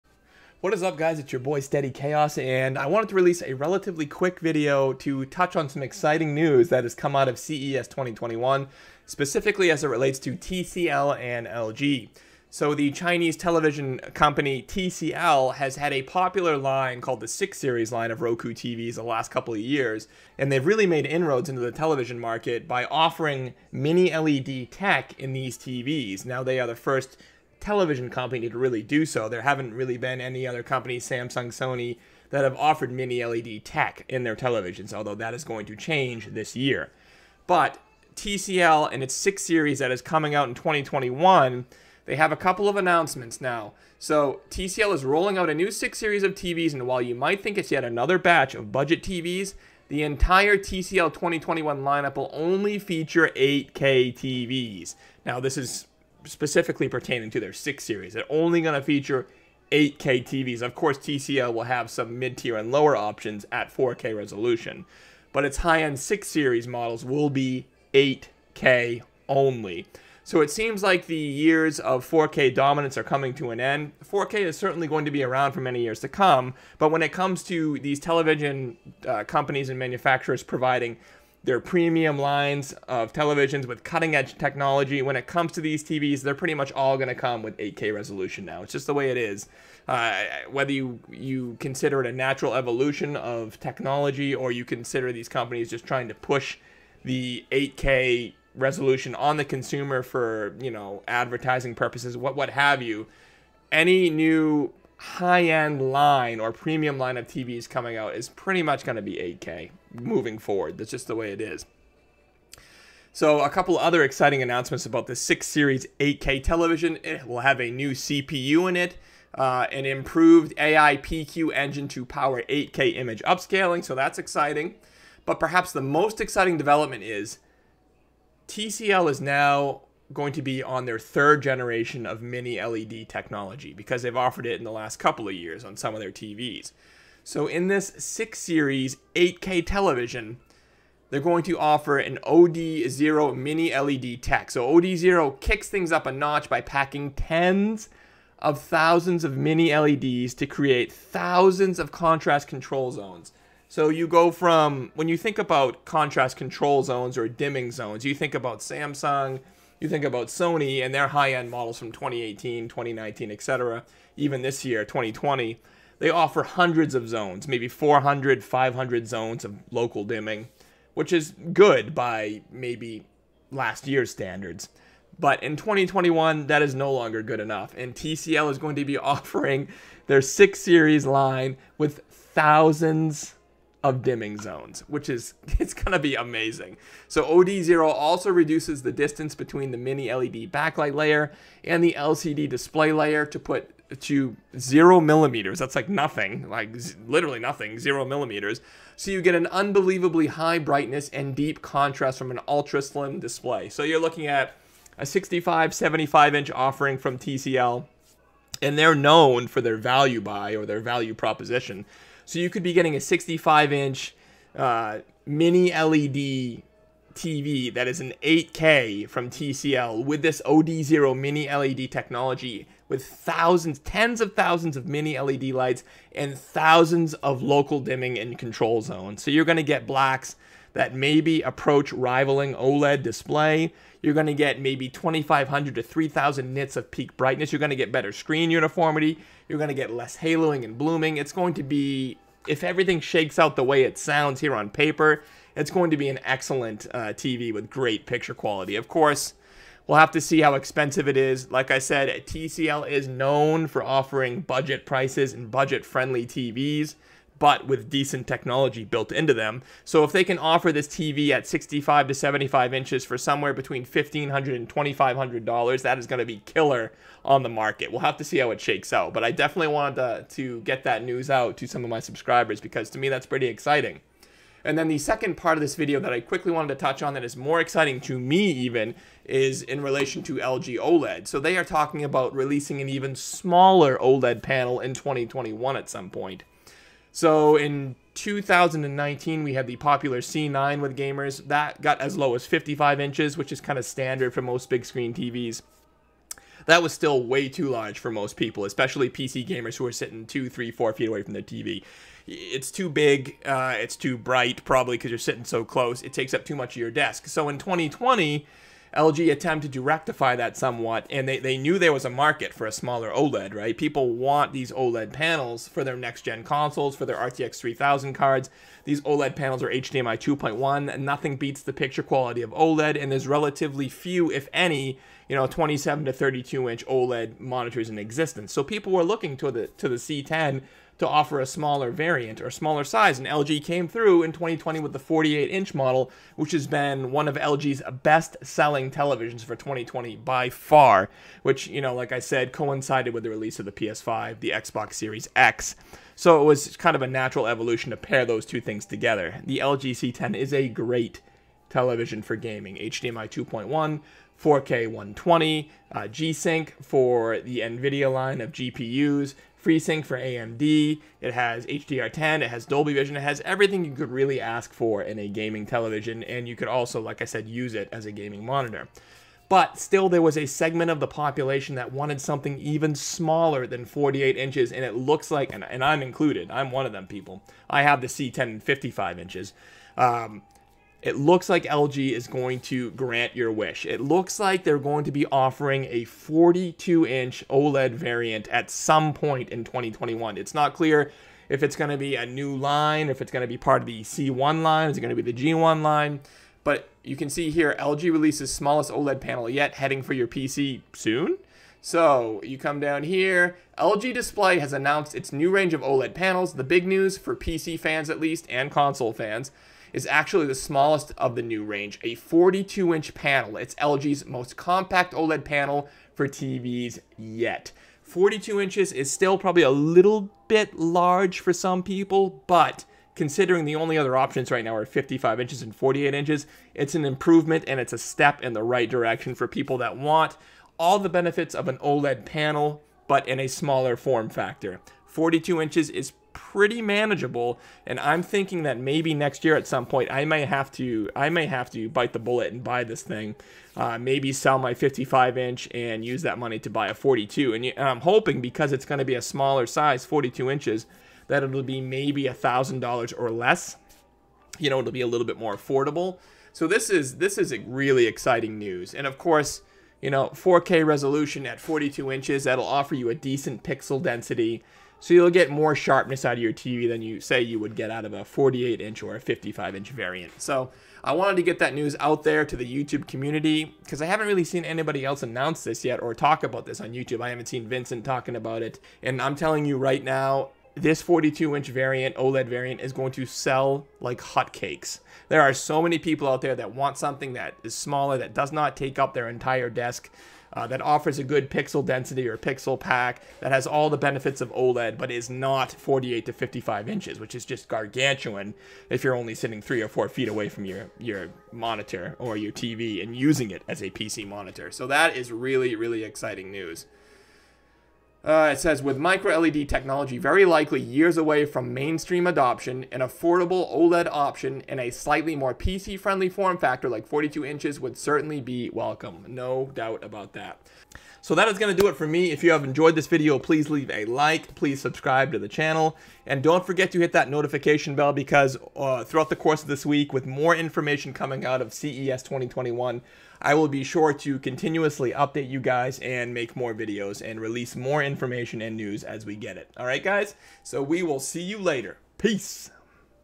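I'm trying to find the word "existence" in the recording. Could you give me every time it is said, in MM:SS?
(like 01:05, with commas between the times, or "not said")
05:27.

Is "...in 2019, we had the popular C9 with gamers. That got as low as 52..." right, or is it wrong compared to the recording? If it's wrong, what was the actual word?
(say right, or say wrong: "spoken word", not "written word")
wrong: "55", not "52".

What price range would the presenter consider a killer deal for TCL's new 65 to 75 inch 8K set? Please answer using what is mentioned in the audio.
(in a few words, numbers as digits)
$1,500 to $2,500.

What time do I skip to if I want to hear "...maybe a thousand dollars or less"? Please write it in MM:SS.
07:31.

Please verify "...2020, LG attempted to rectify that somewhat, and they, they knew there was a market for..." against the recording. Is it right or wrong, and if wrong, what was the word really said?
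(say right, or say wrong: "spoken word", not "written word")
right.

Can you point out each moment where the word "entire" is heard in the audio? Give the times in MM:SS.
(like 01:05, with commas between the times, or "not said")
00:50, 08:09.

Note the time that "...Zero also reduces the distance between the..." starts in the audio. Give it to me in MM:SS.
03:07.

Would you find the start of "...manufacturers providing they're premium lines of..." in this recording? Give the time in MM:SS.
01:19.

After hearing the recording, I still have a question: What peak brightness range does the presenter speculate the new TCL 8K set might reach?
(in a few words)
2,500 to 3,000 nits.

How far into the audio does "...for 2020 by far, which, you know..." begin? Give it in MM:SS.
05:39.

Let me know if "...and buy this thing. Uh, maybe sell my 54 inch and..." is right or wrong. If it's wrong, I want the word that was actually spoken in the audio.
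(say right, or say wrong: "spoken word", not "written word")
wrong: "55", not "54".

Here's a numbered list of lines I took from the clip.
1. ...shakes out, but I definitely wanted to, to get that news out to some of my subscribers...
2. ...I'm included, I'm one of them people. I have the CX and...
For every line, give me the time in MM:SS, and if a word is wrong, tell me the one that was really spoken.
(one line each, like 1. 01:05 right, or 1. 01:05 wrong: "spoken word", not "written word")
1. 04:28 right
2. 06:15 right.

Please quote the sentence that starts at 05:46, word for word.
So it was kind of a natural evolution to pair those two things together.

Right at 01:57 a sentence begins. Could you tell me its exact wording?
It will have a new CPU in it, uh, an improved AI PQ engine to power 8K image upscaling, so that's exciting.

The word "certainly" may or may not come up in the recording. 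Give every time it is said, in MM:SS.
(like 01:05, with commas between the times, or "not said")
01:14, 08:37.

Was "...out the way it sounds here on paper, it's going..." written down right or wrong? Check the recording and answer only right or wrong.
right.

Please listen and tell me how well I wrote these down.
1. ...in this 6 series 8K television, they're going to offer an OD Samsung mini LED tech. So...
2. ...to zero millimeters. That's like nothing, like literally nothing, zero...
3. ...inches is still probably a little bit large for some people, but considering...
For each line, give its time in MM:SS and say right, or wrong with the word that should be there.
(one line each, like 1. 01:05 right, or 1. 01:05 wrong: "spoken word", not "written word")
1. 02:17 wrong: "Zero", not "Samsung"
2. 03:14 right
3. 06:58 right.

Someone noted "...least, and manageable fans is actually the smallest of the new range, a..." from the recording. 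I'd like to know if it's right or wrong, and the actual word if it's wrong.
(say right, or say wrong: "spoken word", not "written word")
wrong: "console", not "manageable".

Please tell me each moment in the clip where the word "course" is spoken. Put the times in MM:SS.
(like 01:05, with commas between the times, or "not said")
01:00, 04:08, 07:39, 08:49.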